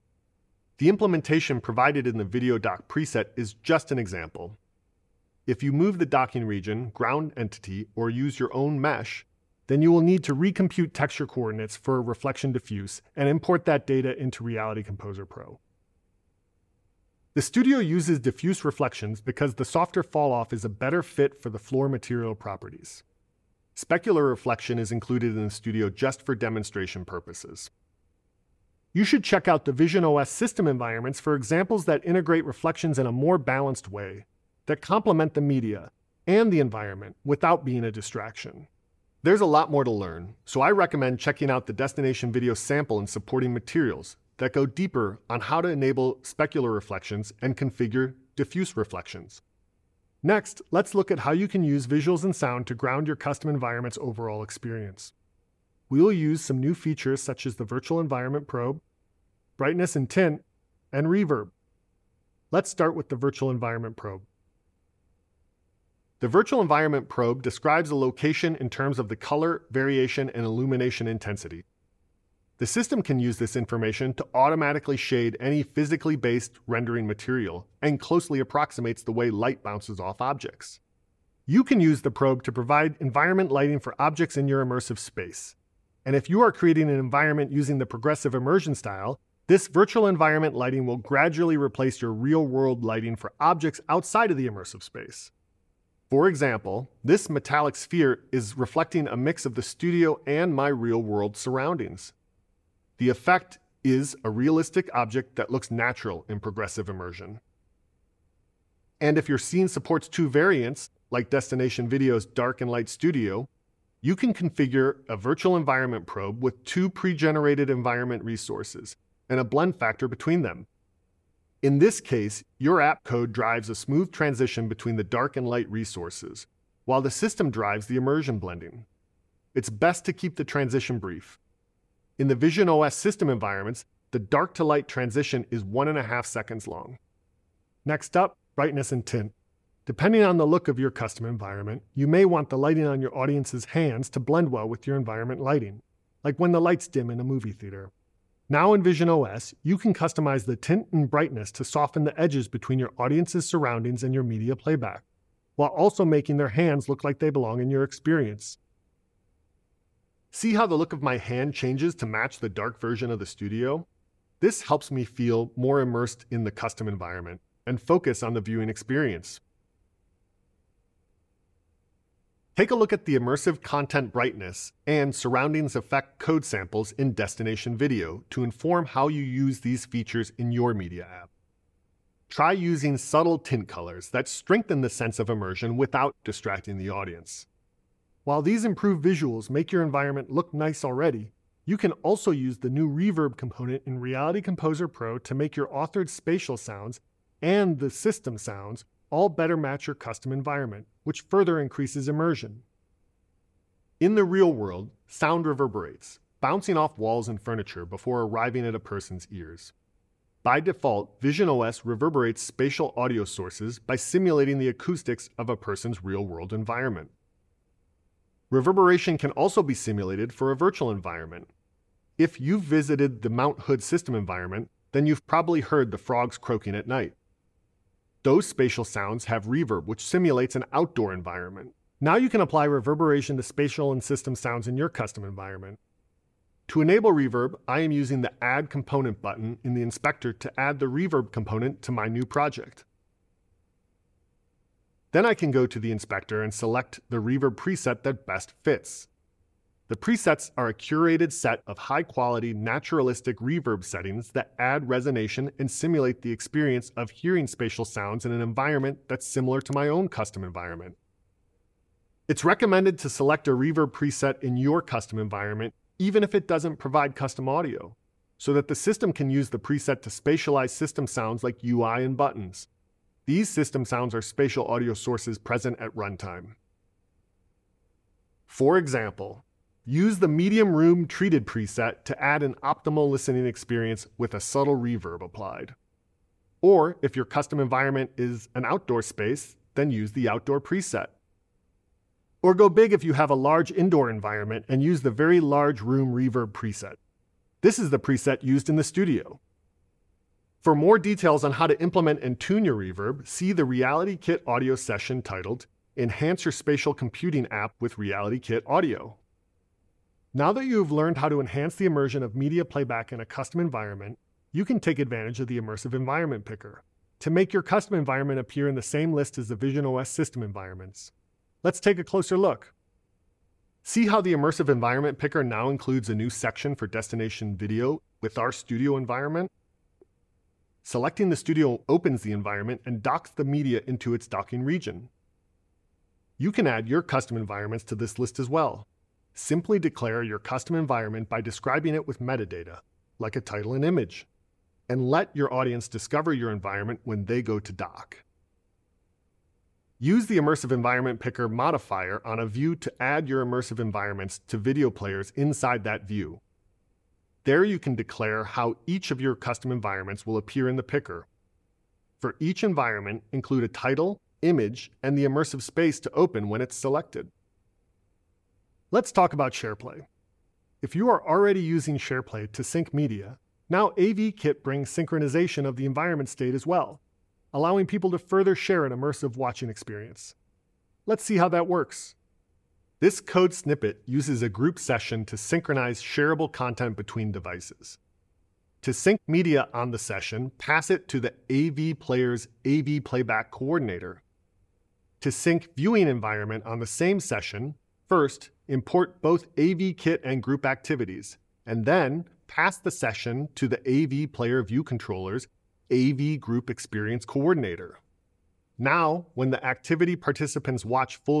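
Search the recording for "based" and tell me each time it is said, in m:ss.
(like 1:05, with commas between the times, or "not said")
1:16.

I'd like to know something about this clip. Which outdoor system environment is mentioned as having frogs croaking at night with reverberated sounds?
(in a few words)
Mount Hood.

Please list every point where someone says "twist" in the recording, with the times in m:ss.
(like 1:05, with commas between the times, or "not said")
not said.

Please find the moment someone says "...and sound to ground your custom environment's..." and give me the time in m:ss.
0:52.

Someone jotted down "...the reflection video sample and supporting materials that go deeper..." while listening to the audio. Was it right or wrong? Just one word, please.
wrong.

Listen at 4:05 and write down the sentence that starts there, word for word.
Then I can go to the inspector and select the reverb preset that best fits.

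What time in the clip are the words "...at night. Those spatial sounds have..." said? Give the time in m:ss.
3:46.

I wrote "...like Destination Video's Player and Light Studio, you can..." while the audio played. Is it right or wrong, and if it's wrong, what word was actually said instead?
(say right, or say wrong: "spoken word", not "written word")
wrong: "Dark", not "Player".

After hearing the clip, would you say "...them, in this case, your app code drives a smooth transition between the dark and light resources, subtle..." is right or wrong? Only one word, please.
wrong.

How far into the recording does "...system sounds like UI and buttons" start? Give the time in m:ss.
4:30.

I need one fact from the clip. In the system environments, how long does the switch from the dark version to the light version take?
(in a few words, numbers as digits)
1.5 seconds.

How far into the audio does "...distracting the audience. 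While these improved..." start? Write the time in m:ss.
3:06.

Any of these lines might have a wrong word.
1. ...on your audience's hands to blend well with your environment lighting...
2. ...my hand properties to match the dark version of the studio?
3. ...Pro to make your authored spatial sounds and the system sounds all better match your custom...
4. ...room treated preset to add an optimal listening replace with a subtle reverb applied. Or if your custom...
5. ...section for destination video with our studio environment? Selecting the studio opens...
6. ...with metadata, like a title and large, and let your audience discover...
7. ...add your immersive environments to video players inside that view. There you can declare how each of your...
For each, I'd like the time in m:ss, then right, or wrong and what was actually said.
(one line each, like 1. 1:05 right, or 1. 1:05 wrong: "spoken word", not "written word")
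1. 2:22 right
2. 2:41 wrong: "changes", not "properties"
3. 3:14 right
4. 4:40 wrong: "experience", not "replace"
5. 5:26 right
6. 5:42 wrong: "image", not "large"
7. 5:53 right.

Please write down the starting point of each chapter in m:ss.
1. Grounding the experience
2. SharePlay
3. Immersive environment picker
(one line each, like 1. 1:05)
1. 0:49
2. 6:08
3. 5:09.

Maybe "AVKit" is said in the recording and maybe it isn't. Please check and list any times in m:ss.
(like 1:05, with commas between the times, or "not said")
6:13, 6:39.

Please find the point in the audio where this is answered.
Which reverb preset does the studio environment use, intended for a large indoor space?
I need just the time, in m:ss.
4:55.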